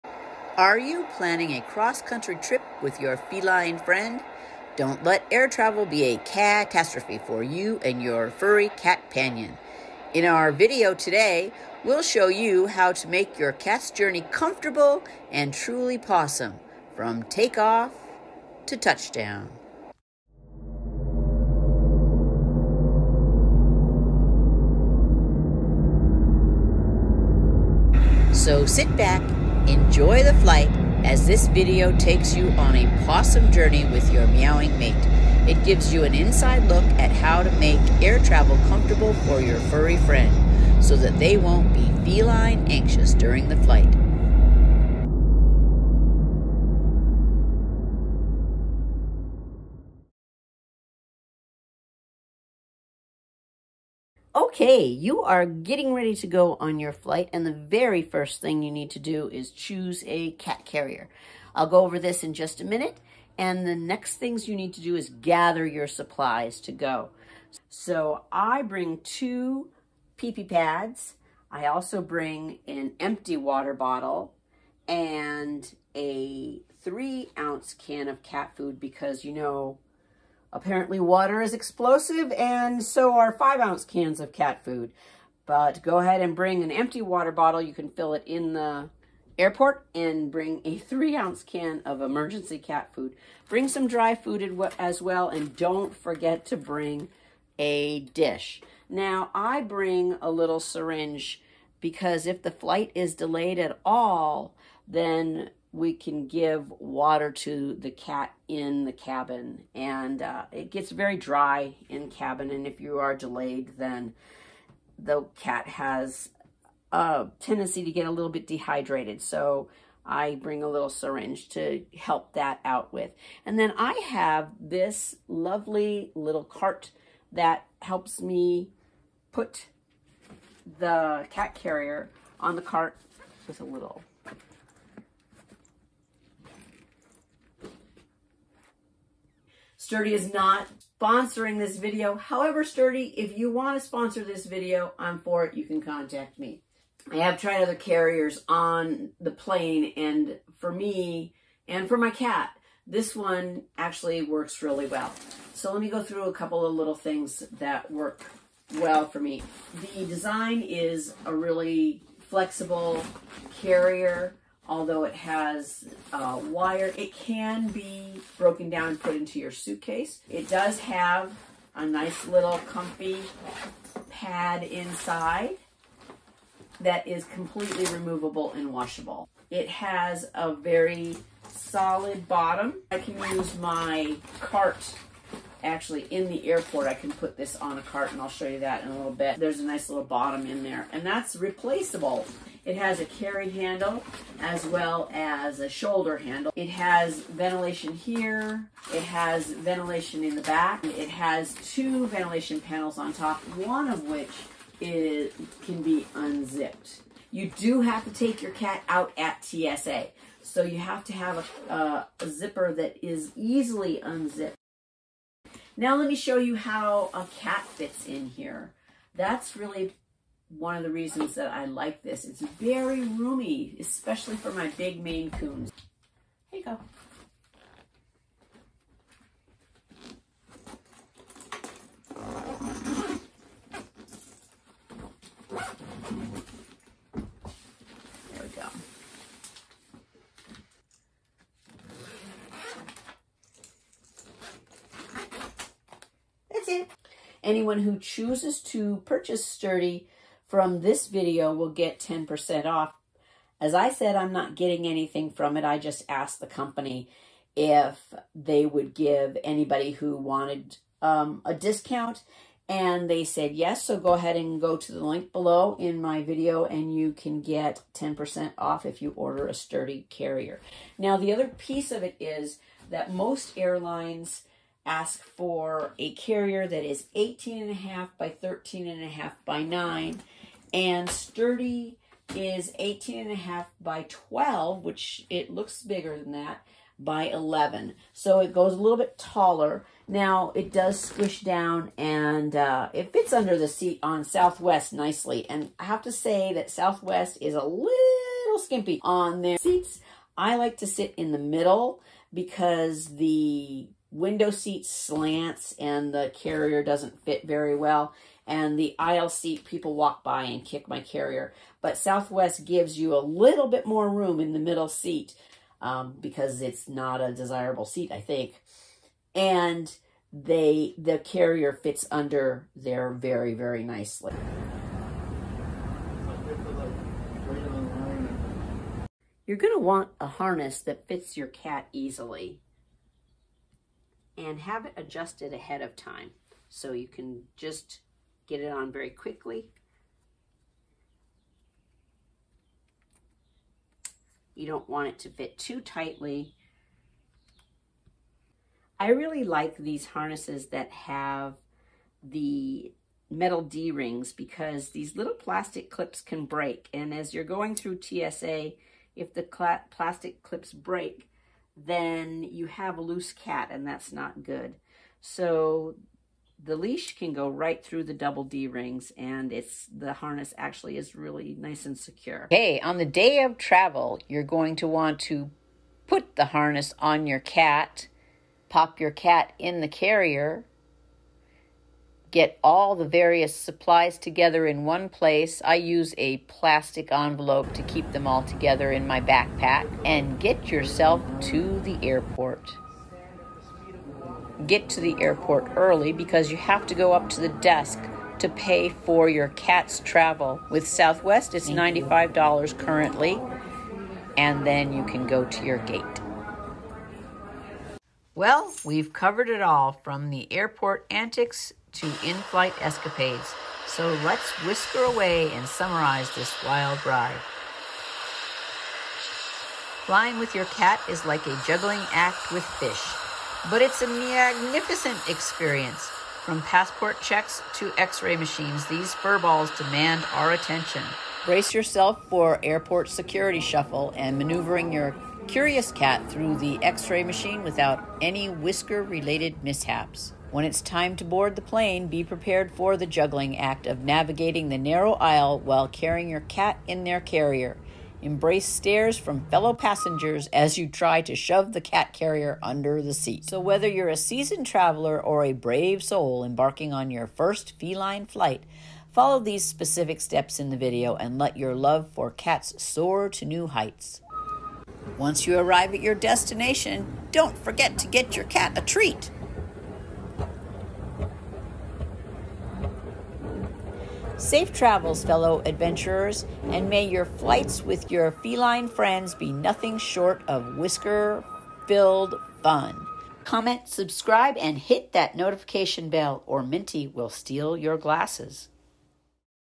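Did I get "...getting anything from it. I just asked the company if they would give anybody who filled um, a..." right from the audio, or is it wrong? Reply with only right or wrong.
wrong.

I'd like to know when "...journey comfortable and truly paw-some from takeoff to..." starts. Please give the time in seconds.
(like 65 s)
13 s.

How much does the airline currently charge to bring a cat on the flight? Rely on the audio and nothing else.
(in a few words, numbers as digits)
$95.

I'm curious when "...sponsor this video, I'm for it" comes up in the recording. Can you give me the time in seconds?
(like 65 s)
143 s.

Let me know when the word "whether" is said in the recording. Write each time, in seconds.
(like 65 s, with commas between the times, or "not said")
453 s.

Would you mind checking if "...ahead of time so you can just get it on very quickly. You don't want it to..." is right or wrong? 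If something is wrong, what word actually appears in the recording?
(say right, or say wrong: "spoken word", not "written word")
right.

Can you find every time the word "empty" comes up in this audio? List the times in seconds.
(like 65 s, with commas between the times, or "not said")
73 s, 86 s.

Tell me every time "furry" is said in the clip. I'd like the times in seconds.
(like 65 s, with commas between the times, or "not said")
8 s, 39 s.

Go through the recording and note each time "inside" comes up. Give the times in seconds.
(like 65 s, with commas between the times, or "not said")
36 s, 174 s.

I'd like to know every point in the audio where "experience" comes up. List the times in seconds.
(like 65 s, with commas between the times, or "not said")
425 s.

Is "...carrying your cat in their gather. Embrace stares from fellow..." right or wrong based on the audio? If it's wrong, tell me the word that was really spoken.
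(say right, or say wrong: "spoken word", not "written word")
wrong: "carrier", not "gather".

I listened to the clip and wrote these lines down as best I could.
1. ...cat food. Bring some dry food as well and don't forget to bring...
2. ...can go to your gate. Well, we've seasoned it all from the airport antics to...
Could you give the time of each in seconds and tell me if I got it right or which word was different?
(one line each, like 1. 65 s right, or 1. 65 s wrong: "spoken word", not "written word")
1. 92 s right
2. 405 s wrong: "covered", not "seasoned".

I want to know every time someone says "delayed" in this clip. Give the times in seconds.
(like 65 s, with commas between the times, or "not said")
103 s, 113 s.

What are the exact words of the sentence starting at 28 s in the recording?
So sit back Enjoy the flight as this video takes you on a paw-some journey with your meowing mate.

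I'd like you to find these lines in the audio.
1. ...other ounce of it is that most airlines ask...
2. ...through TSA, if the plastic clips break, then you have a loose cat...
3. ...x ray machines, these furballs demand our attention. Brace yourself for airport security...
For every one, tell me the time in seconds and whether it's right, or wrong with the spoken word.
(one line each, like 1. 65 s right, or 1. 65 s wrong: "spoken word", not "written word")
1. 271 s wrong: "piece", not "ounce"
2. 357 s right
3. 427 s right.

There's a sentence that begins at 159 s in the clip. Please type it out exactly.
The design is a really flexible carrier although it has uh, wire, it can be broken down and put into your suitcase.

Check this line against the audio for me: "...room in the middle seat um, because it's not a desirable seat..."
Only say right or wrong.
right.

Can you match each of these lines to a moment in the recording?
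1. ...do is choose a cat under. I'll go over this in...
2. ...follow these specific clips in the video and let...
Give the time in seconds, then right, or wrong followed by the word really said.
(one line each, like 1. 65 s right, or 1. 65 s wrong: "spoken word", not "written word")
1. 58 s wrong: "carrier", not "under"
2. 459 s wrong: "steps", not "clips".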